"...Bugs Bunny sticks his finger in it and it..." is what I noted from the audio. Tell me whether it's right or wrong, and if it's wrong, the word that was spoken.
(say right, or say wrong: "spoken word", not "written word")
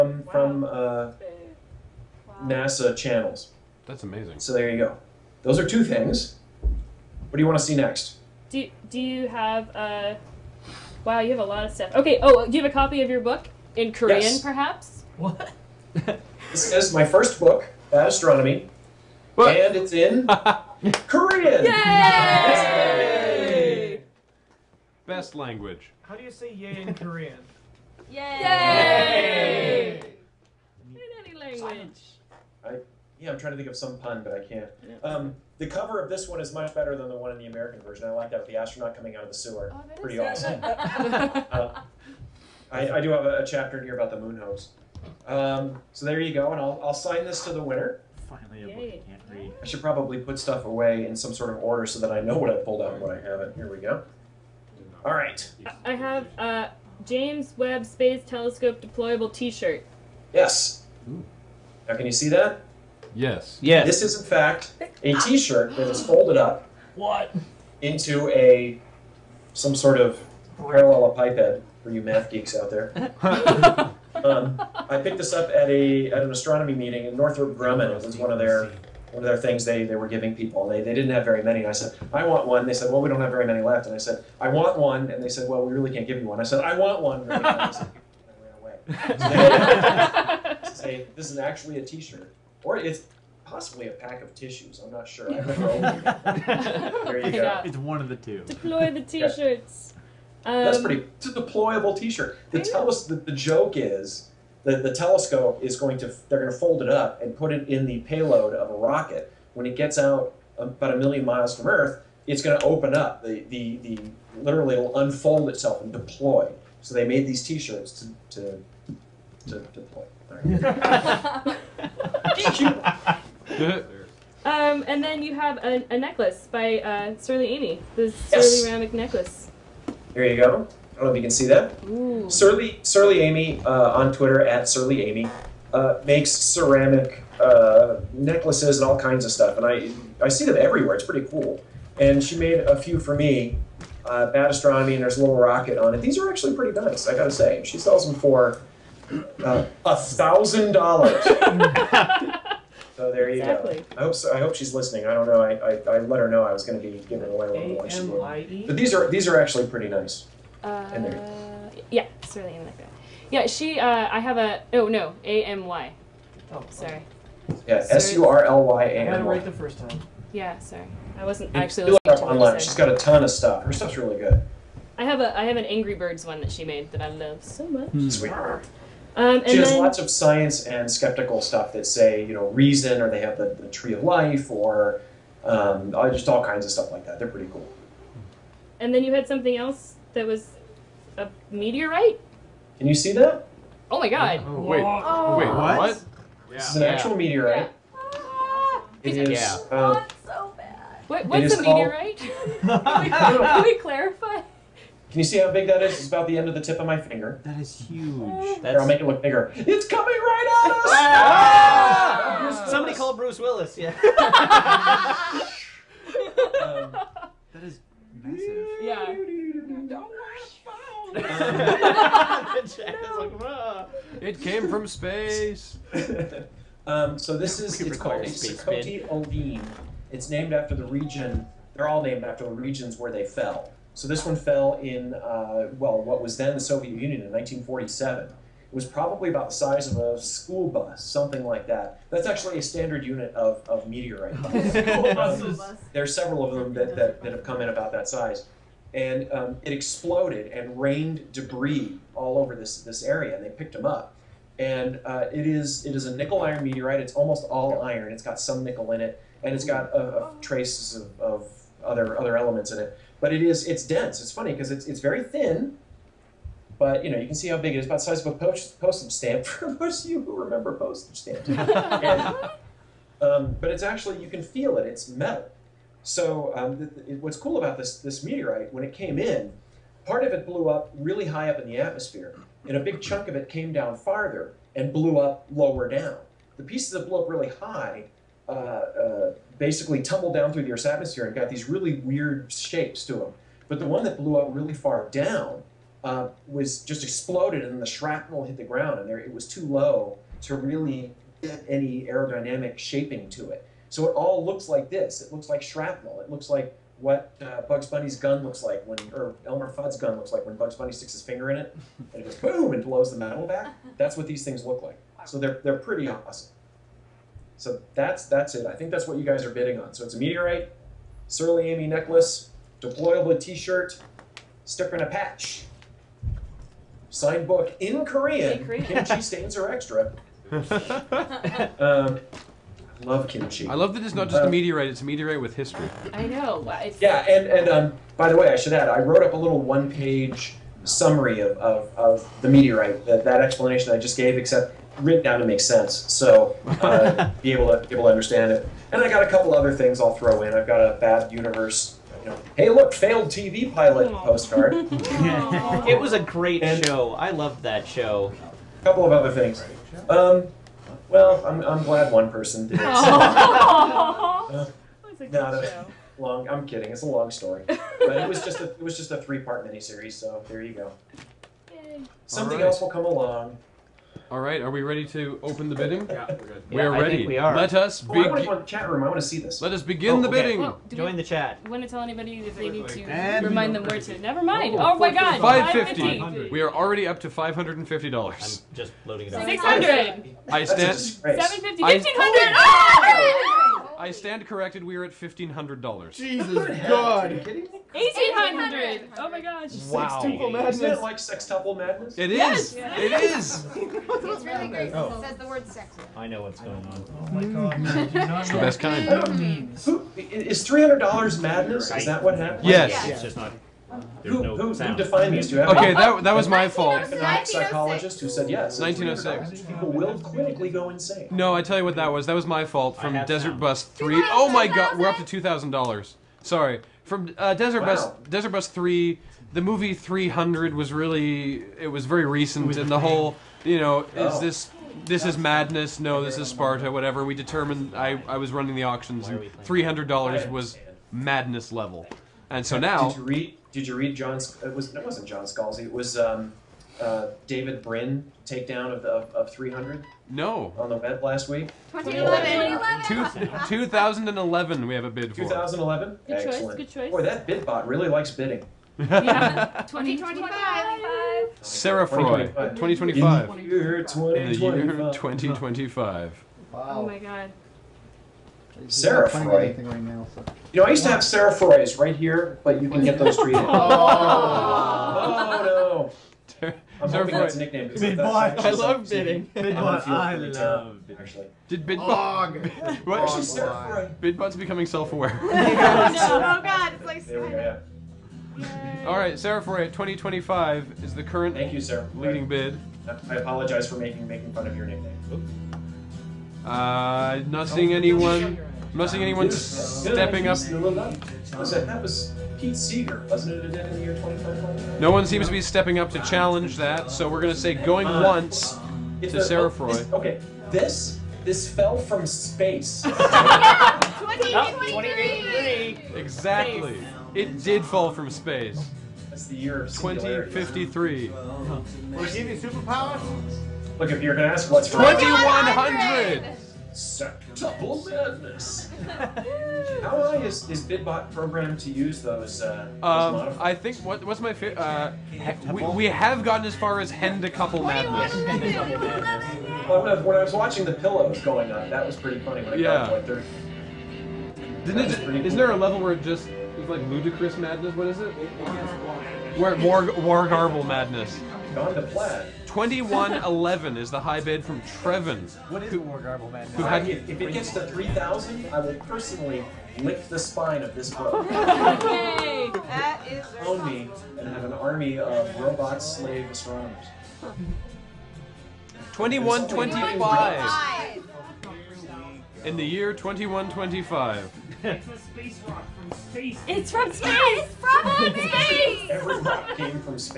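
right.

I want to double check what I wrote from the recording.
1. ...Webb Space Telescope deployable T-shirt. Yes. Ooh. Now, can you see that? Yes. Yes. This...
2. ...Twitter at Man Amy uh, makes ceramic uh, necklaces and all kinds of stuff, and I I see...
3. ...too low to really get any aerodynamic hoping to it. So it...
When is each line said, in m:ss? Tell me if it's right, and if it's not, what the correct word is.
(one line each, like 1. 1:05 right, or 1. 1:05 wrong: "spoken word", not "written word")
1. 0:57 right
2. 2:14 wrong: "Surly", not "Man"
3. 4:59 wrong: "shaping", not "hoping".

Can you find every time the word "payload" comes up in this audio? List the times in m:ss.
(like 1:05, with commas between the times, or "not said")
1:47.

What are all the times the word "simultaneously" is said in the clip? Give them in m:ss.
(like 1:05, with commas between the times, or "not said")
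not said.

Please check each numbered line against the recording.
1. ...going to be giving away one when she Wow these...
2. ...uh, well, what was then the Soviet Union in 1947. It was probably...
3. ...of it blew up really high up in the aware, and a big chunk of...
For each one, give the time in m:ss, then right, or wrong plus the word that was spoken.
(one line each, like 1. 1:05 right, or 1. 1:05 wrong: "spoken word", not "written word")
1. 2:36 wrong: "But", not "Wow"
2. 3:55 right
3. 4:40 wrong: "atmosphere", not "aware".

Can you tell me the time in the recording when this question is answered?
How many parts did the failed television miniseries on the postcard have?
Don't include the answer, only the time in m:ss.
6:09.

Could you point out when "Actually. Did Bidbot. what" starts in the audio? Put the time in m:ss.
8:01.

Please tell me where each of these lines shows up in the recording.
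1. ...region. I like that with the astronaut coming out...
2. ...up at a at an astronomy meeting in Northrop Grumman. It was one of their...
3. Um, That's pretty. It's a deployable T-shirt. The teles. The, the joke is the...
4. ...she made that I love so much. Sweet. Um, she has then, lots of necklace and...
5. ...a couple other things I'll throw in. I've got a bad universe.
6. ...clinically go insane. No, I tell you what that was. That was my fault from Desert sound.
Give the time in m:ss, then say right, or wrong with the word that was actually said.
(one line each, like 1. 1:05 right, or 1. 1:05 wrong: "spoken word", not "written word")
1. 0:37 wrong: "version", not "region"
2. 1:15 right
3. 1:40 right
4. 2:56 wrong: "science", not "necklace"
5. 5:49 right
6. 7:00 right.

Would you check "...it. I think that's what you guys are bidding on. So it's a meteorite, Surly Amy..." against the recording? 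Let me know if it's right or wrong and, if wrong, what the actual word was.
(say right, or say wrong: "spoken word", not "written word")
right.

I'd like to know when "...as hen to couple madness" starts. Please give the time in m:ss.
8:56.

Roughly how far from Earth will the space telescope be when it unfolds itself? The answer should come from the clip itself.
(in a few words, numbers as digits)
a million miles.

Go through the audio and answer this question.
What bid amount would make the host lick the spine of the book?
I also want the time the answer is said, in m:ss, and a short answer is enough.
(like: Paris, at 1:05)
3,000, at 9:17.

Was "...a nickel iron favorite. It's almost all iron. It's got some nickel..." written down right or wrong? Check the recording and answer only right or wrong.
wrong.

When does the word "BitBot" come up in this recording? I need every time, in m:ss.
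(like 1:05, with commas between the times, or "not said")
7:37, 8:50.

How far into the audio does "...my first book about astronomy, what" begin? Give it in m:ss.
0:16.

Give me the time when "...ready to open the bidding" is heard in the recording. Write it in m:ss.
6:14.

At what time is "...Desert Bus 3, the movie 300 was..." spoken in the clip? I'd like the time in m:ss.
7:08.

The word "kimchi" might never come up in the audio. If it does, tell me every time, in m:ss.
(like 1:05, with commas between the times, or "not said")
5:28, 5:33.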